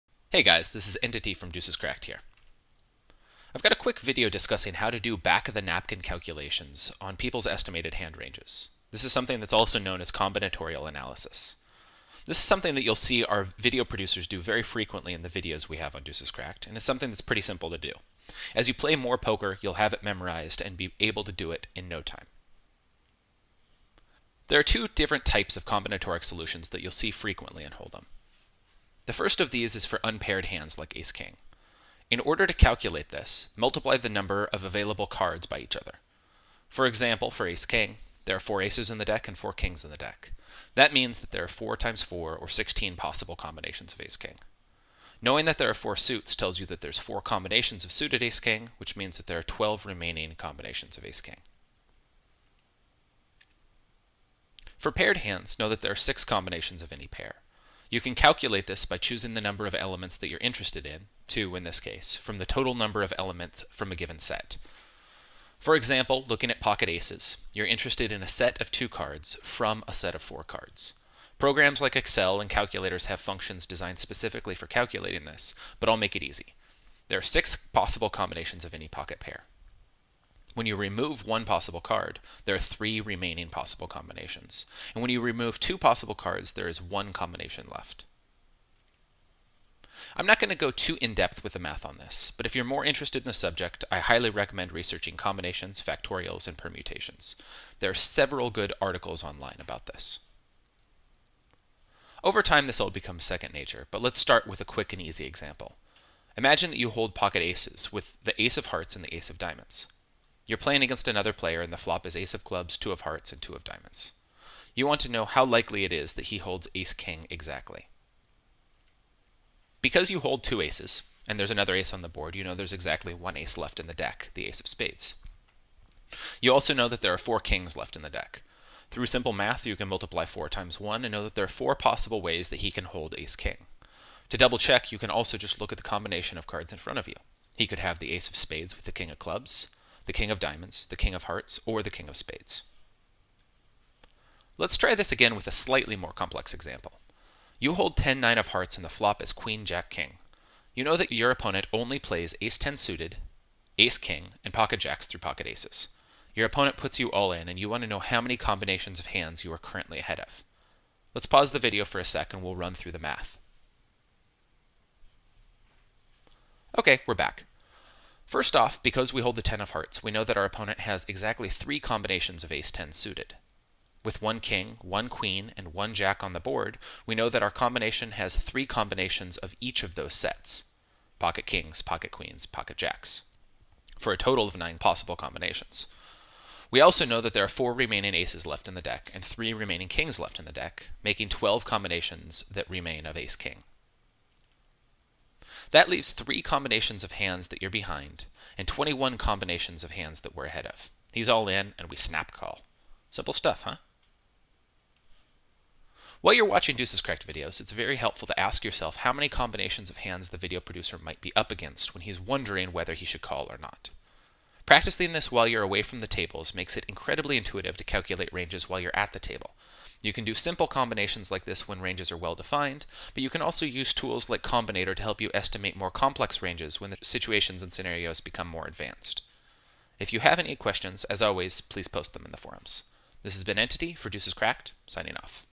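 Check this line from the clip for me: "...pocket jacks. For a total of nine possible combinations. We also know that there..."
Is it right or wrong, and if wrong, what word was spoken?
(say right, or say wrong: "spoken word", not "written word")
right.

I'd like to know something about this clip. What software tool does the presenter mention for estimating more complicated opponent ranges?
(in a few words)
Combinator.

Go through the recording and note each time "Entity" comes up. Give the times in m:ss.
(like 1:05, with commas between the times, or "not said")
0:01, 3:53.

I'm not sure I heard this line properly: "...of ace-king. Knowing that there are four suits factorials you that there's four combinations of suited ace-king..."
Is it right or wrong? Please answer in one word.
wrong.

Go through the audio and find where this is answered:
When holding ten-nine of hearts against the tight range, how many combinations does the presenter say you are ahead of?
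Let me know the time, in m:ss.
3:18.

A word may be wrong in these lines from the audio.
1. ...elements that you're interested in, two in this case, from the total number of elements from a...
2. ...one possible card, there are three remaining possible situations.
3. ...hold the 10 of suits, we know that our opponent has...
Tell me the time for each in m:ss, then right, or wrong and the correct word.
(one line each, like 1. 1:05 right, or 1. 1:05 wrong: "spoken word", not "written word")
1. 0:59 right
2. 1:21 wrong: "combinations", not "situations"
3. 2:49 wrong: "hearts", not "suits".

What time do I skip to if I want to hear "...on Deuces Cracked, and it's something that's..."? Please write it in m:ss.
0:15.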